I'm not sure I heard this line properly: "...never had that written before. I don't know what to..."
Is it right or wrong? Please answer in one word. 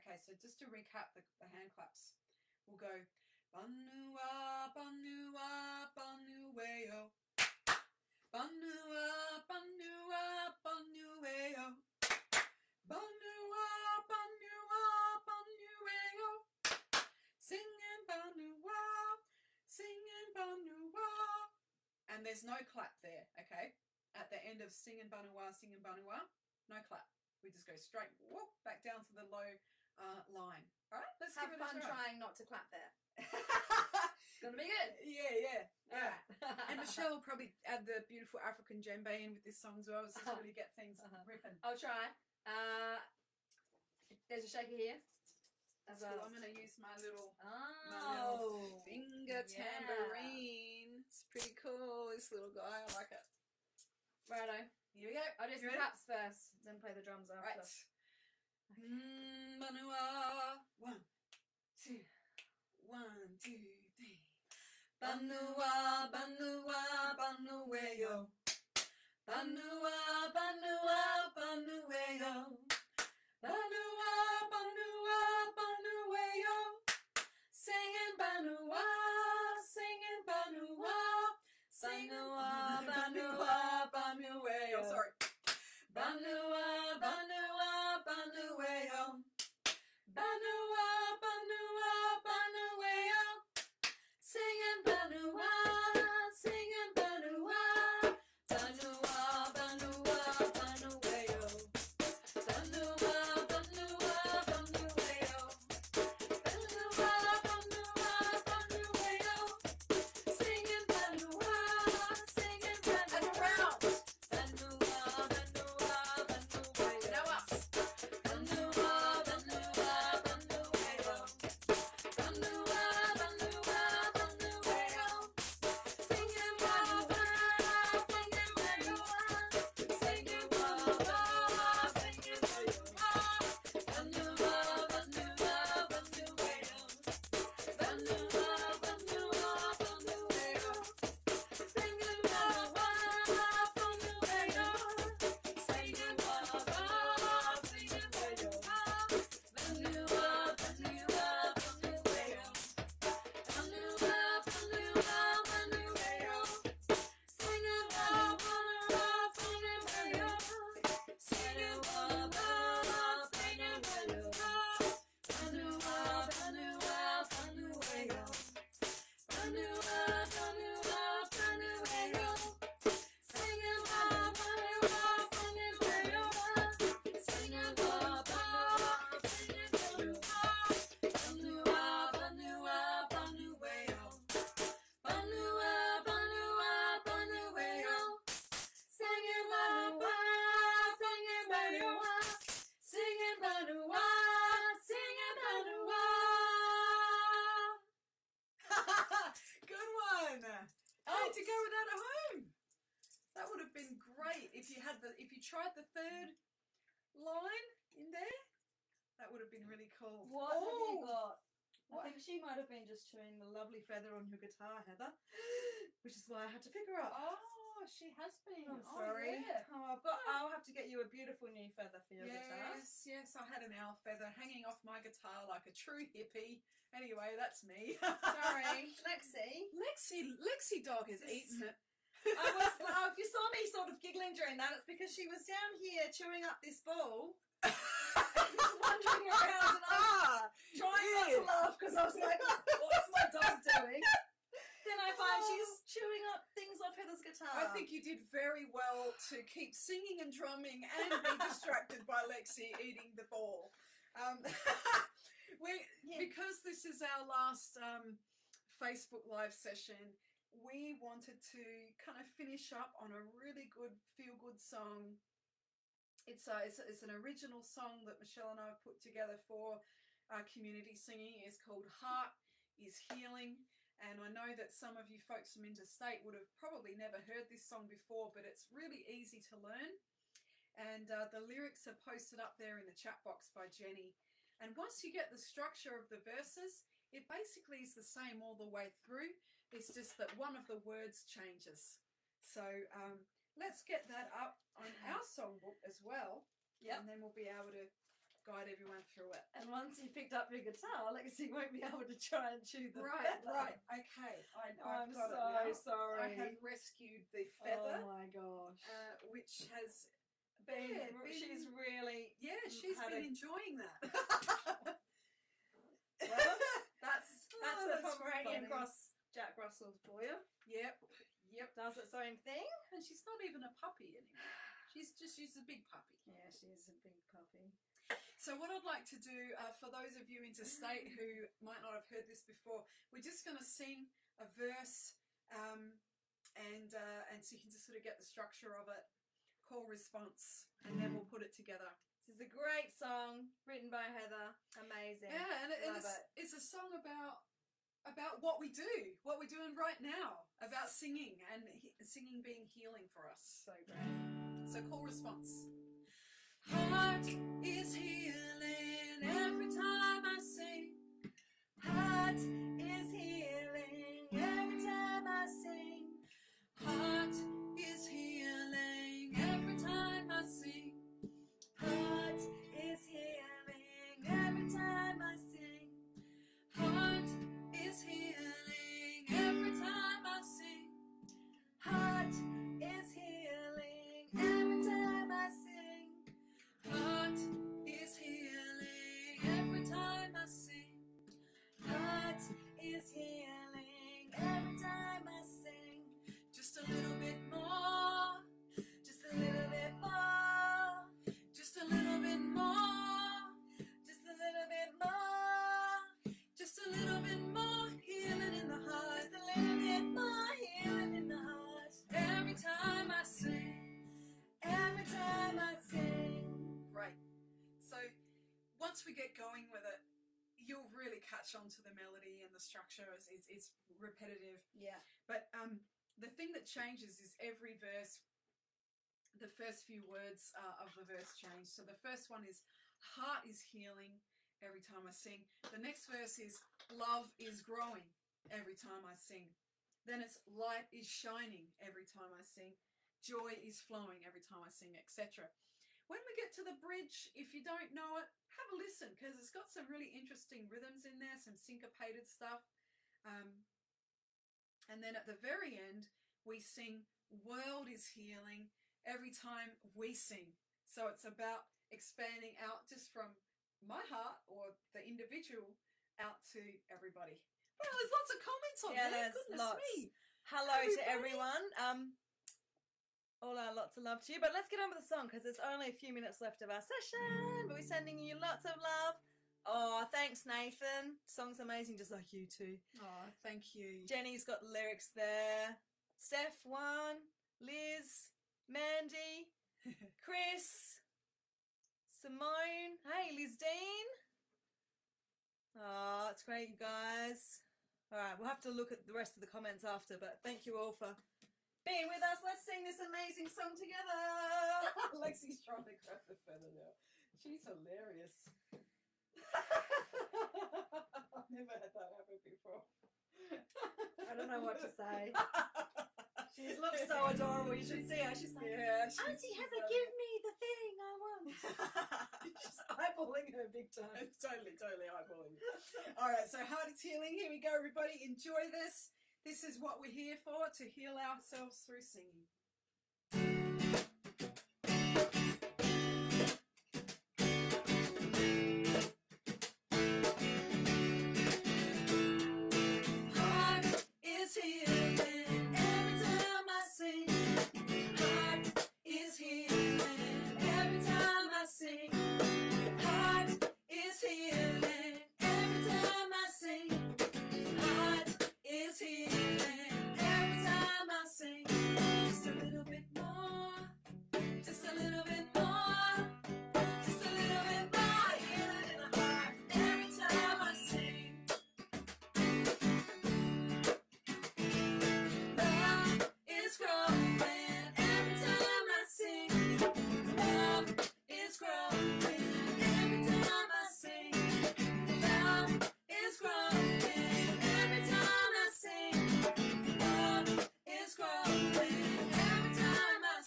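wrong.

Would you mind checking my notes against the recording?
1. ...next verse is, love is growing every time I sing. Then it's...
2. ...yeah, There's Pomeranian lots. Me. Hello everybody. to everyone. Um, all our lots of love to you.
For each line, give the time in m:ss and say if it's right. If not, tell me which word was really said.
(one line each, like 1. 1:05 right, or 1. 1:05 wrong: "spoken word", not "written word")
1. 7:15 right
2. 7:48 wrong: "Goodness", not "Pomeranian".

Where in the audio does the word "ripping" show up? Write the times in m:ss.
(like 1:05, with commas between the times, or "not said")
0:41.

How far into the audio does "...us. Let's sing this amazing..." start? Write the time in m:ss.
8:22.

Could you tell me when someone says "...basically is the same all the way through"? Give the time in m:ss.
4:47.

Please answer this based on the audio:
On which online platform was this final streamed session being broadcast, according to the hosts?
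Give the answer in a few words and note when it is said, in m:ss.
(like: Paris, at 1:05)
Facebook Live, at 4:18.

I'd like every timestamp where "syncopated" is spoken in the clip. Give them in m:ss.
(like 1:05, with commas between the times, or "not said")
7:31.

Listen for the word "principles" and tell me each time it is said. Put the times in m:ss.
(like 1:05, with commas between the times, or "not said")
not said.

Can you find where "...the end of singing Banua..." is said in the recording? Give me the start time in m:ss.
0:24.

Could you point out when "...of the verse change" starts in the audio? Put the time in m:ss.
7:10.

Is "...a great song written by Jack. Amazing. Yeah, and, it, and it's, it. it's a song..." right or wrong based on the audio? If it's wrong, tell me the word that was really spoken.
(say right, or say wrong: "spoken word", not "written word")
wrong: "Heather", not "Jack".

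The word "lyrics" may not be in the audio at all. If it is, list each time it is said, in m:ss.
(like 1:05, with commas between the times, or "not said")
4:41, 8:04.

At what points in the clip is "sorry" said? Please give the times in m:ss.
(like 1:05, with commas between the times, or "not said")
1:24, 3:38, 3:47, 5:05.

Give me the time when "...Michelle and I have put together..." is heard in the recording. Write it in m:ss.
4:28.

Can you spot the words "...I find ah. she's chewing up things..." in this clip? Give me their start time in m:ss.
4:04.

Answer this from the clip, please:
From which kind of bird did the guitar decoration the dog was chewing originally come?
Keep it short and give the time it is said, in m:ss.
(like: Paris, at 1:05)
owl, at 3:43.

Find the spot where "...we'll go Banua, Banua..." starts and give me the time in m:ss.
0:02.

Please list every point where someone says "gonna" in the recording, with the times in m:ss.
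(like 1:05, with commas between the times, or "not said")
0:34, 0:46.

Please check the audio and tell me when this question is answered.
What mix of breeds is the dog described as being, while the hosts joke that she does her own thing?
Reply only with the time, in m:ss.
5:18.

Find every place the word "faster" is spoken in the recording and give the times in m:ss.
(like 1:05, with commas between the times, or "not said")
not said.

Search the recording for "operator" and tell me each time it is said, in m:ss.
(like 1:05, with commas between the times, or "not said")
not said.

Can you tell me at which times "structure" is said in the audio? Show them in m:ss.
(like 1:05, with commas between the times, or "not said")
4:45, 5:38, 7:02.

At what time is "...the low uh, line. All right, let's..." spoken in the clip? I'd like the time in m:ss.
0:29.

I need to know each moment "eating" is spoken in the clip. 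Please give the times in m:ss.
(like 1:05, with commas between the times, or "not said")
3:51, 4:12.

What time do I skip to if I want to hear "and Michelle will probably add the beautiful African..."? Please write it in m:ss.
0:36.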